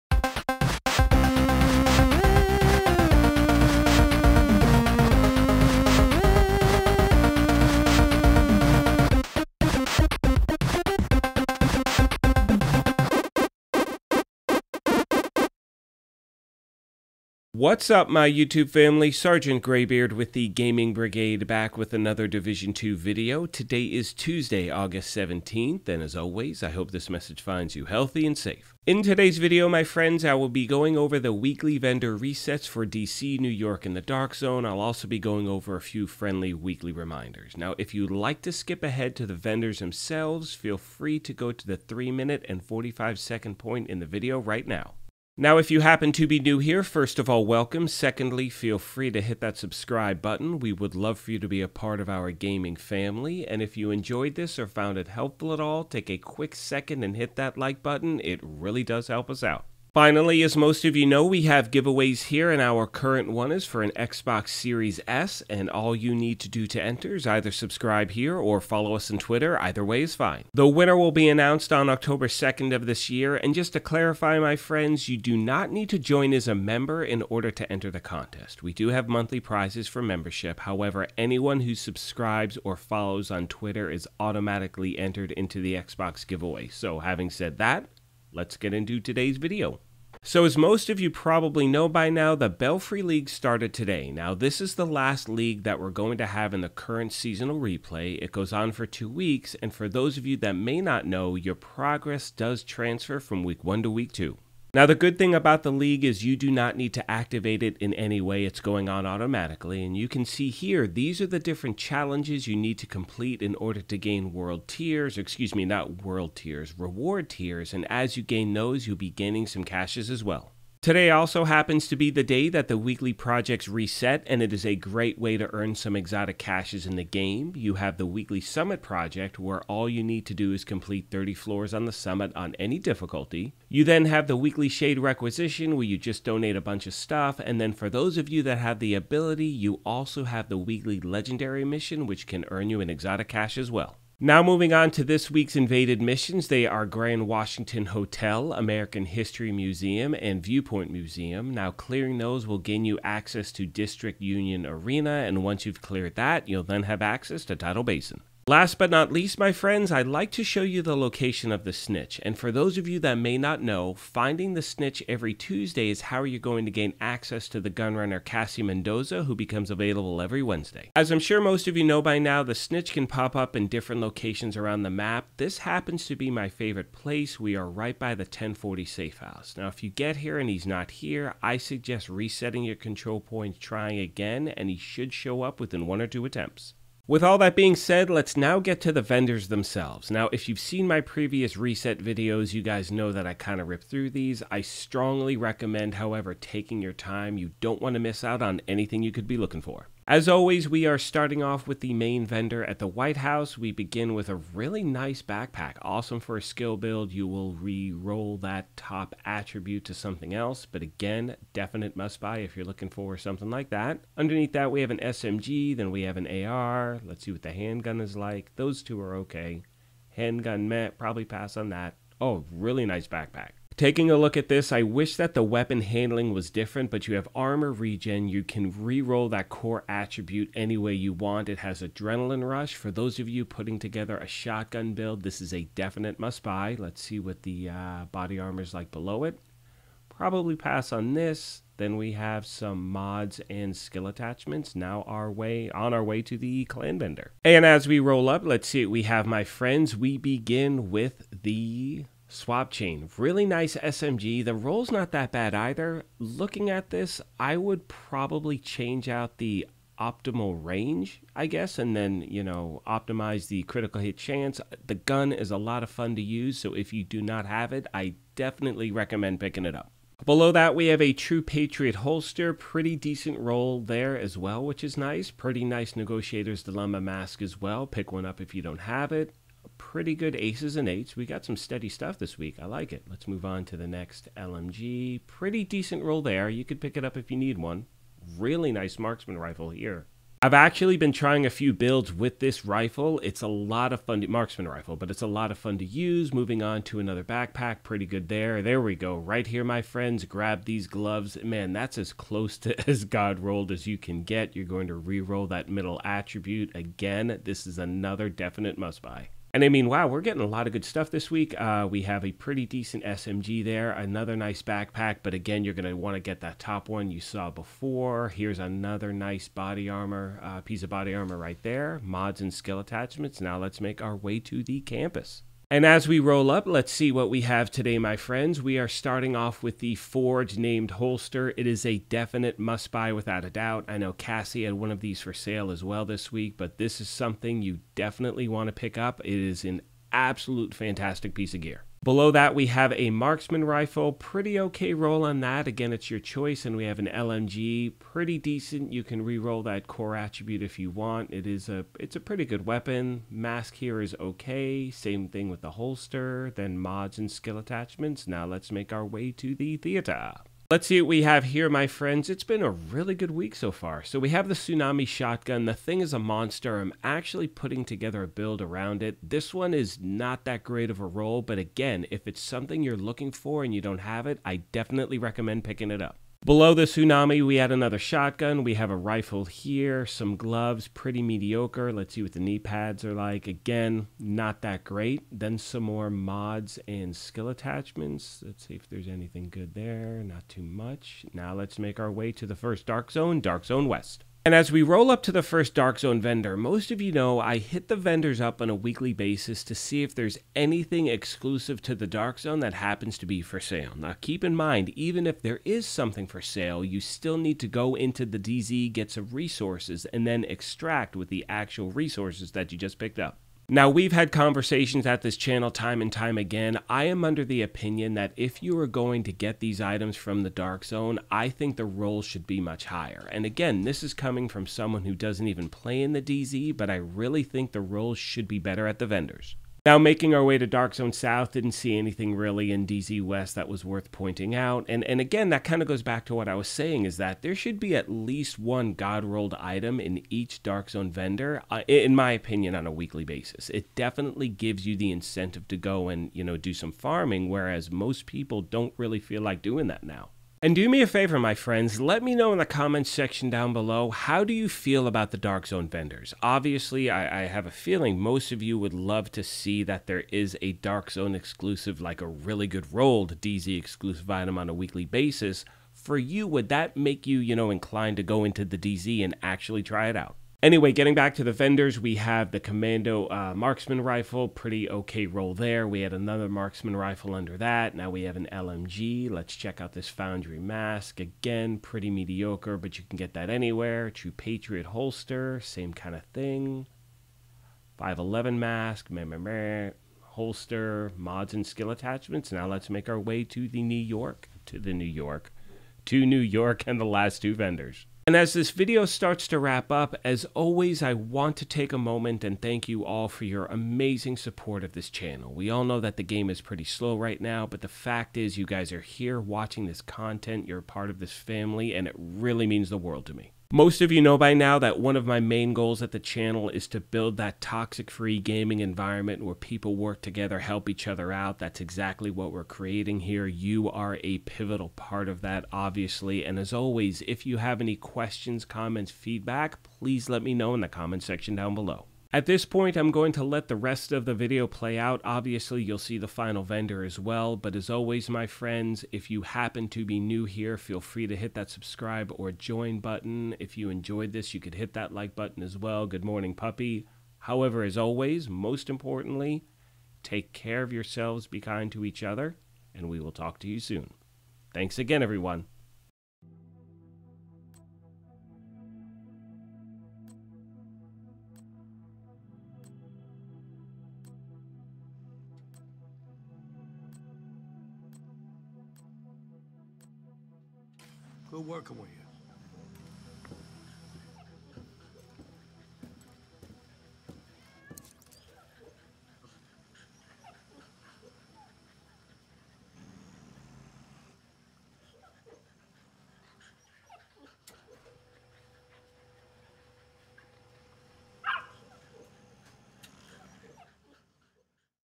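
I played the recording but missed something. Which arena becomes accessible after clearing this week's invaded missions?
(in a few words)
District Union Arena.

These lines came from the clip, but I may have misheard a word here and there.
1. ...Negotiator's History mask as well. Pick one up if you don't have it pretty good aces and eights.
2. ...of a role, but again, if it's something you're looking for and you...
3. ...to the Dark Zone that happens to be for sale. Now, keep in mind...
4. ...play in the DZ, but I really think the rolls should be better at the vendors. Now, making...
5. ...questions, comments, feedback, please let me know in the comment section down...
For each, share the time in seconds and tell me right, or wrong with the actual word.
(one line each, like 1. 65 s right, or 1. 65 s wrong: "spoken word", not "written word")
1. 275 s wrong: "Dilemma", not "History"
2. 370 s right
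3. 401 s right
4. 425 s right
5. 527 s right.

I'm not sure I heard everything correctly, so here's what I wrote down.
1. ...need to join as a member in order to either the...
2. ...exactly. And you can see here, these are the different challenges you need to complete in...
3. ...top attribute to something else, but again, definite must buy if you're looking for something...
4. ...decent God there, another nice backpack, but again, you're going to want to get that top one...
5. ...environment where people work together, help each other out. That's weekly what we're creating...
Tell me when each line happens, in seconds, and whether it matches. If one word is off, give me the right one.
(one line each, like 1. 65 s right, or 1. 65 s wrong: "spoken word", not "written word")
1. 75 s wrong: "enter", not "either"
2. 109 s wrong: "automatically", not "exactly"
3. 208 s right
4. 312 s wrong: "SMG", not "God"
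5. 518 s wrong: "exactly", not "weekly".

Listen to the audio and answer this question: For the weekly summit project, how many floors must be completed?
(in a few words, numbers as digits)
30.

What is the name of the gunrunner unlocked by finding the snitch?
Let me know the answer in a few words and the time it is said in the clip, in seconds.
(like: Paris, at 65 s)
Cassie Mendoza, at 168 s.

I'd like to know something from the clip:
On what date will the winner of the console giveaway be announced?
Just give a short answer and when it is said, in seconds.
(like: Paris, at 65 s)
October 2nd, at 71 s.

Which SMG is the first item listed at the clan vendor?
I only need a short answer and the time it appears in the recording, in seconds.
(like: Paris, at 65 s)
Swap Chain, at 252 s.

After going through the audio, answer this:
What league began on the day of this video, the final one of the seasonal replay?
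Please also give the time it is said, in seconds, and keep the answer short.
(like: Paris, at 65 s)
Belfry League, at 92 s.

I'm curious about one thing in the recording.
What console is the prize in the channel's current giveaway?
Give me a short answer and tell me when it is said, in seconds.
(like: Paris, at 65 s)
Xbox Series S, at 63 s.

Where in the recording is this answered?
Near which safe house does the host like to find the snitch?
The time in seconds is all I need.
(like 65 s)
178 s.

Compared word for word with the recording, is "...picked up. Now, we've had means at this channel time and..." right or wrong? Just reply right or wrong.
wrong.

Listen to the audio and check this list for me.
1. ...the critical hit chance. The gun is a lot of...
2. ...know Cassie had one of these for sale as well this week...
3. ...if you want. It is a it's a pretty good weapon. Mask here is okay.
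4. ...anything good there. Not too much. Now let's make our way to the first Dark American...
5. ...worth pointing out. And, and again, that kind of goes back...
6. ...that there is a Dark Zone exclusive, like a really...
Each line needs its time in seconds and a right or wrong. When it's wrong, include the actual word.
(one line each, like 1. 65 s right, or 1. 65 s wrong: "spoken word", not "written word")
1. 263 s right
2. 333 s right
3. 350 s right
4. 389 s wrong: "Zone", not "American"
5. 433 s right
6. 459 s right.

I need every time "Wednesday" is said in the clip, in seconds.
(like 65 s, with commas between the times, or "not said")
170 s.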